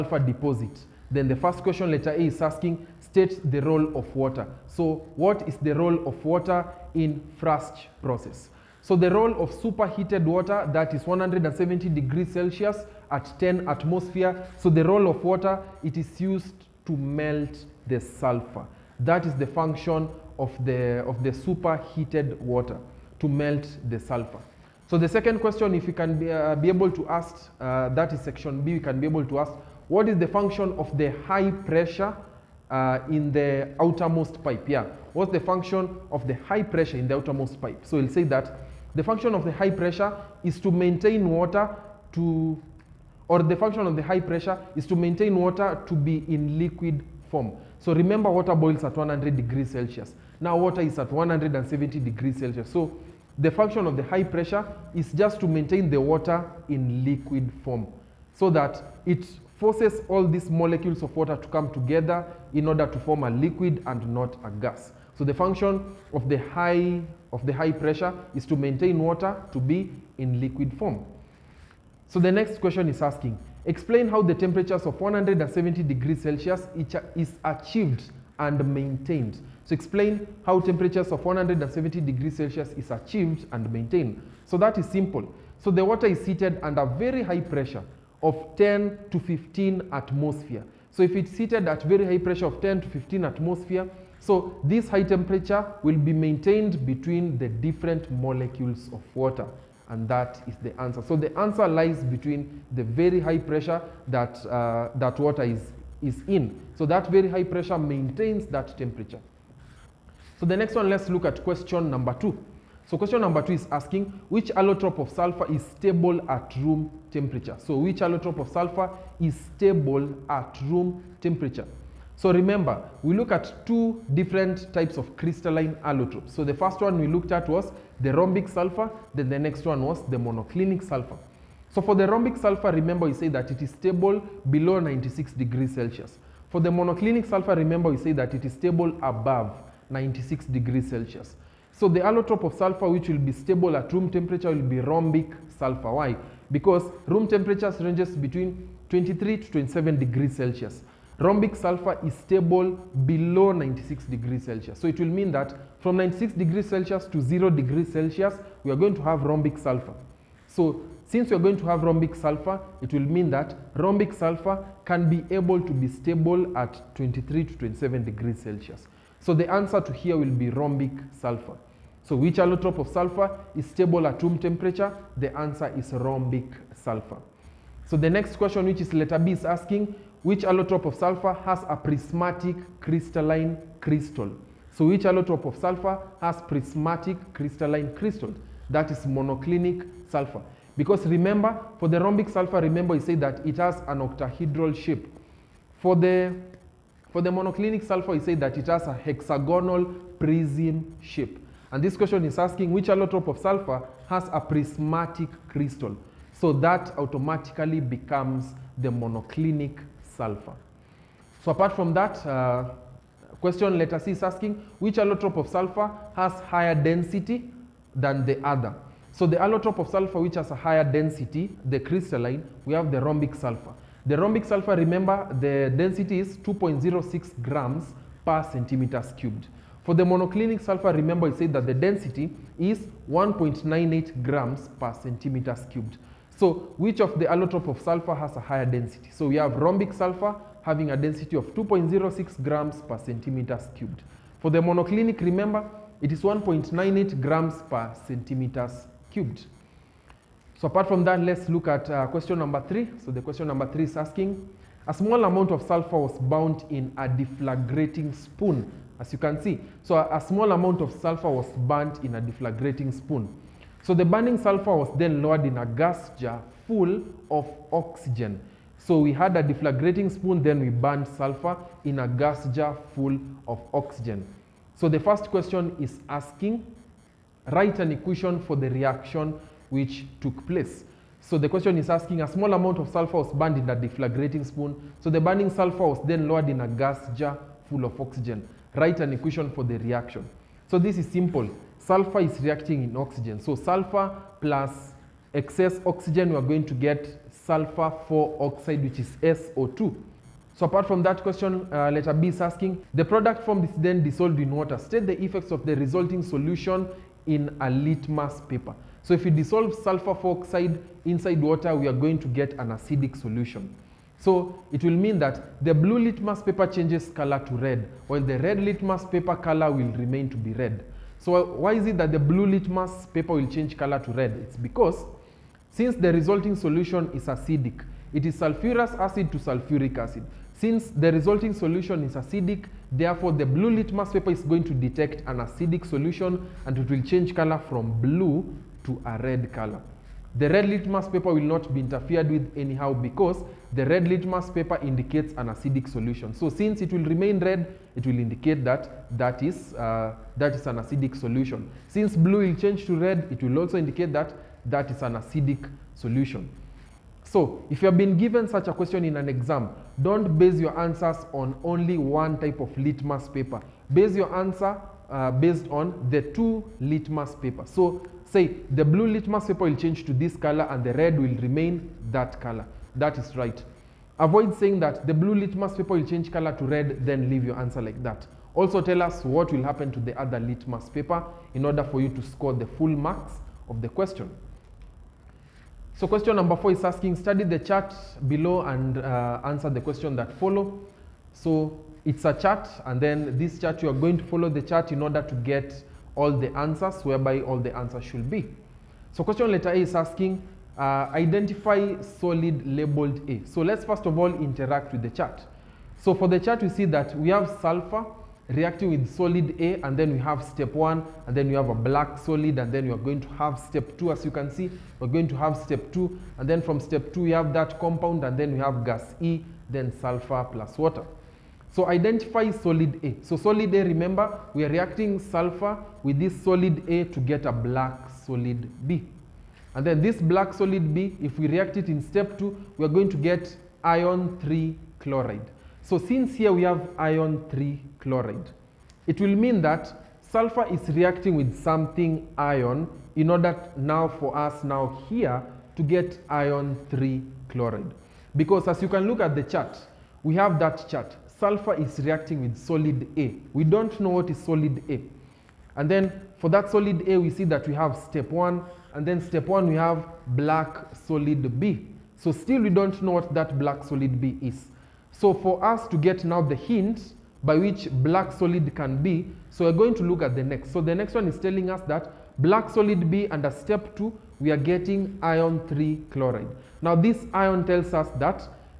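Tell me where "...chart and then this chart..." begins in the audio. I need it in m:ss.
6:32.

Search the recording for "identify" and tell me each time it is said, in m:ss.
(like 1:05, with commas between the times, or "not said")
6:41, 7:01.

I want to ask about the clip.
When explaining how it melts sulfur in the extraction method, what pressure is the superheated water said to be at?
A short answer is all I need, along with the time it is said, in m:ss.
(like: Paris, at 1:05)
10 atmosphere, at 0:13.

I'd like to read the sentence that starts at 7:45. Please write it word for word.
So for us to get now the hint by which black solid can be, so we're going to look at the next.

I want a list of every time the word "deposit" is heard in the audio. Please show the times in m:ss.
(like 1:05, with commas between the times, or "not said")
0:00.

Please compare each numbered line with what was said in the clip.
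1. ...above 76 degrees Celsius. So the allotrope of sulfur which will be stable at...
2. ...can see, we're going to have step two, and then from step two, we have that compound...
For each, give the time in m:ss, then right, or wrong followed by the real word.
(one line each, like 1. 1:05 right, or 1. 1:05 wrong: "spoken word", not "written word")
1. 2:19 wrong: "96", not "76"
2. 6:54 right.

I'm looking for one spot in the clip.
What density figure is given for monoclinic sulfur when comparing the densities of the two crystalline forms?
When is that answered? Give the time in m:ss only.
3:53.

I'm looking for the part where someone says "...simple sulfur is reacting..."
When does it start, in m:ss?
4:51.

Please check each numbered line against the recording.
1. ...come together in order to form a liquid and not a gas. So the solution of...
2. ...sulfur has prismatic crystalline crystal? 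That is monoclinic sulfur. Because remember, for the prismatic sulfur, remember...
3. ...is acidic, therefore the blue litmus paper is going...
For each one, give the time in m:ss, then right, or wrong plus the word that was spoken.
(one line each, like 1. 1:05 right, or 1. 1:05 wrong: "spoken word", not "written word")
1. 1:01 wrong: "function", not "solution"
2. 3:05 wrong: "rhombic", not "prismatic"
3. 5:32 right.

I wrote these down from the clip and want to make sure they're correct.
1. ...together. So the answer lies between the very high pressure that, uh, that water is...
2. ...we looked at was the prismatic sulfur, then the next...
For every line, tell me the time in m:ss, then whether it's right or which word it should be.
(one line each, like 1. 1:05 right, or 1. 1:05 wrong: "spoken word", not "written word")
1. 1:40 wrong: "answer", not "together"
2. 2:06 wrong: "rhombic", not "prismatic".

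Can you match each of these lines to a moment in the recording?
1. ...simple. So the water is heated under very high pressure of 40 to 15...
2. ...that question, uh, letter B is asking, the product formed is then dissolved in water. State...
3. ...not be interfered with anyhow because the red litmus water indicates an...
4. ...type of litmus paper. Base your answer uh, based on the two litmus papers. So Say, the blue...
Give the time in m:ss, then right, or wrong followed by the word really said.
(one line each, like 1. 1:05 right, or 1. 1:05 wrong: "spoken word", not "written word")
1. 1:24 wrong: "10", not "40"
2. 5:01 right
3. 5:41 wrong: "paper", not "water"
4. 6:02 right.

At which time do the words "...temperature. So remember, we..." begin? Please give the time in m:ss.
2:01.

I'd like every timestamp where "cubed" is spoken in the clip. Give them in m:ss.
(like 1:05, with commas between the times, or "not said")
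3:49, 3:55, 4:03, 4:09.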